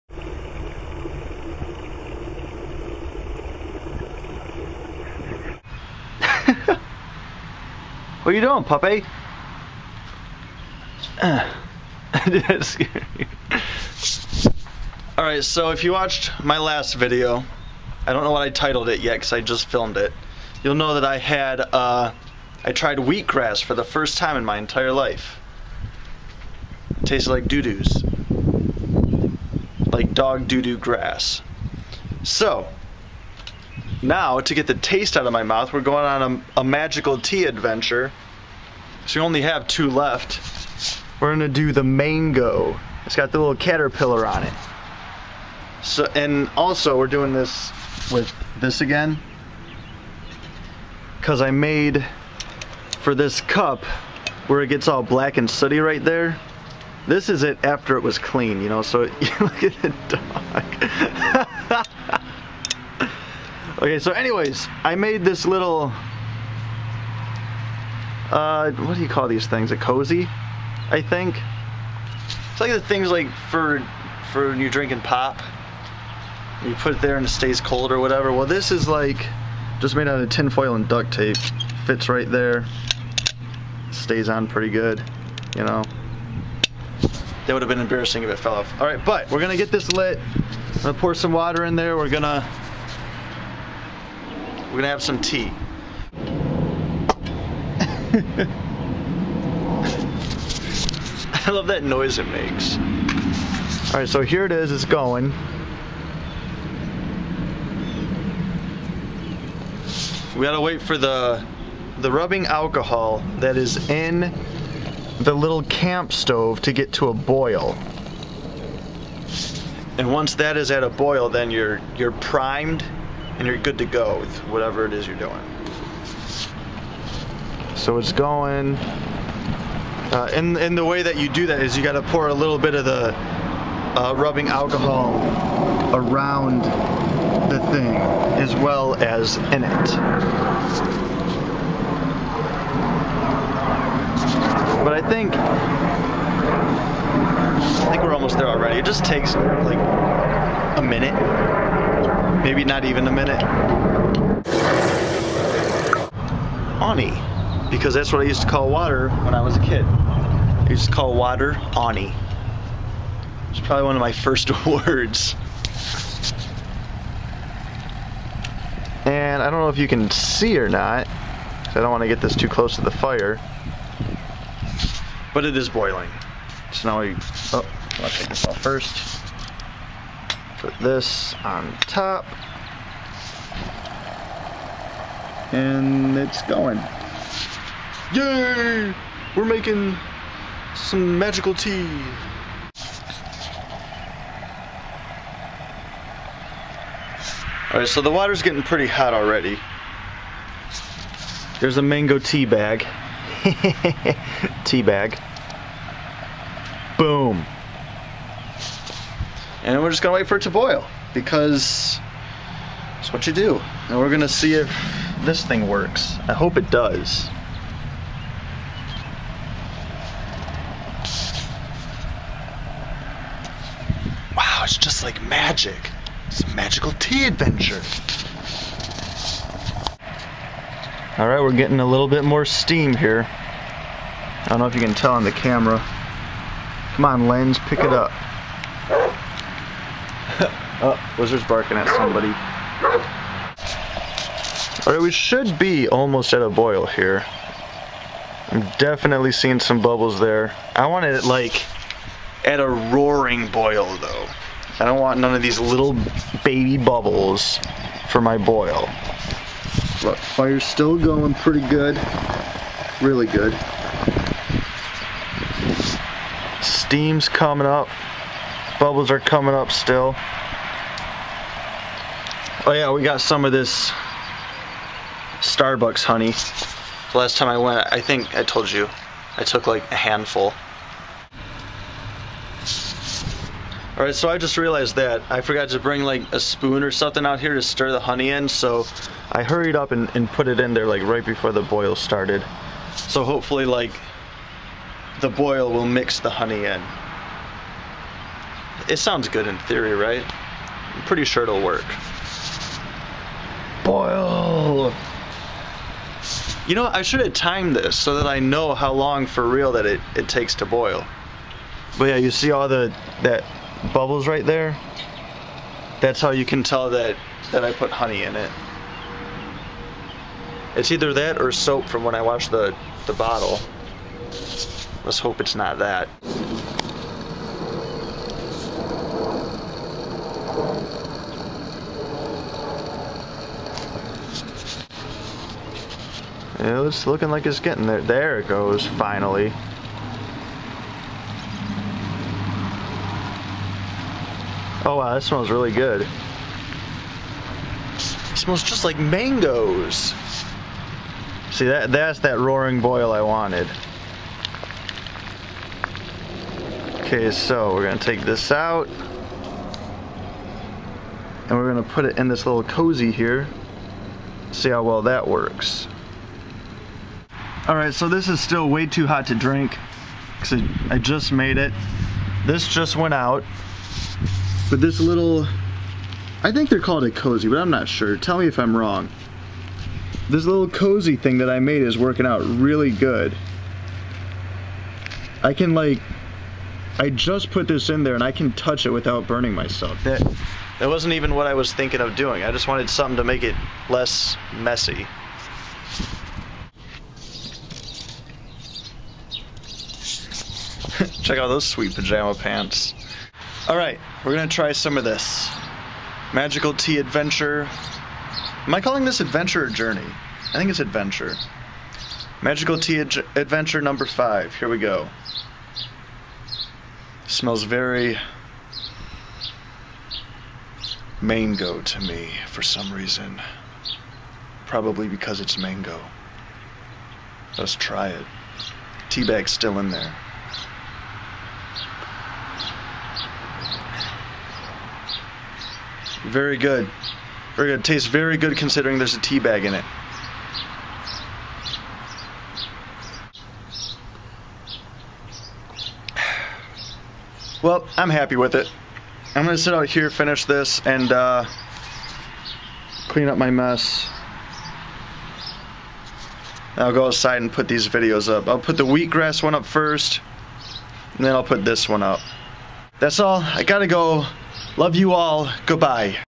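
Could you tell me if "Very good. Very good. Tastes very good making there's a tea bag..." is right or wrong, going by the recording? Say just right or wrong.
wrong.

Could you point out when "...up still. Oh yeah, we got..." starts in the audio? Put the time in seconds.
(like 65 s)
269 s.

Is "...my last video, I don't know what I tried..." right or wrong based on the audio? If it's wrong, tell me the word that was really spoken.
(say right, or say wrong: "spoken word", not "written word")
wrong: "titled", not "tried".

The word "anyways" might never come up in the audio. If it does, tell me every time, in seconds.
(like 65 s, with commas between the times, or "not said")
64 s.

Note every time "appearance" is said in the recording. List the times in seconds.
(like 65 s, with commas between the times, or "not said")
not said.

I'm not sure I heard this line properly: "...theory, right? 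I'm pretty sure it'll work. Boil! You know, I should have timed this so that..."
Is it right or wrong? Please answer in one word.
right.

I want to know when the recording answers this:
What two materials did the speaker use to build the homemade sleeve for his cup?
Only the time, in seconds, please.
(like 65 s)
80 s.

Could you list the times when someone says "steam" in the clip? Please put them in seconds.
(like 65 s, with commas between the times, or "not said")
232 s, 266 s.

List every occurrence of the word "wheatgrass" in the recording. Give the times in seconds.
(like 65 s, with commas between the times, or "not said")
22 s, 458 s.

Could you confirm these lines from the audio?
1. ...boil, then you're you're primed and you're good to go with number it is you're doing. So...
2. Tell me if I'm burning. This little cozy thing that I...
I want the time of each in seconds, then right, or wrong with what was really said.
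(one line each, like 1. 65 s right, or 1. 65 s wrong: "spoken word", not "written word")
1. 120 s wrong: "whatever", not "number"
2. 378 s wrong: "wrong", not "burning".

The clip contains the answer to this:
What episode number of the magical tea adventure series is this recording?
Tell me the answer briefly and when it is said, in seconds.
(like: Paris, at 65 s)
5, at 414 s.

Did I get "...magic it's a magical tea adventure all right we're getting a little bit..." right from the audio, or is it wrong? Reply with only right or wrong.
right.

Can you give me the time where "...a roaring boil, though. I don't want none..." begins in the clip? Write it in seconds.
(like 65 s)
252 s.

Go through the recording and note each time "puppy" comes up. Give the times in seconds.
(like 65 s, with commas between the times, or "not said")
8 s.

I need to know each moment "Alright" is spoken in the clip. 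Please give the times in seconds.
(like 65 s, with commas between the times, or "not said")
15 s, 103 s, 197 s, 244 s.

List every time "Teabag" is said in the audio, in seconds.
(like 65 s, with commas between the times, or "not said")
429 s.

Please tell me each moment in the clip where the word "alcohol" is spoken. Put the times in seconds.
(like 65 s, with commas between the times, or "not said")
112 s, 134 s.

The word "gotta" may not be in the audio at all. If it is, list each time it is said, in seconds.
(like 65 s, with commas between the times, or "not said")
110 s, 463 s.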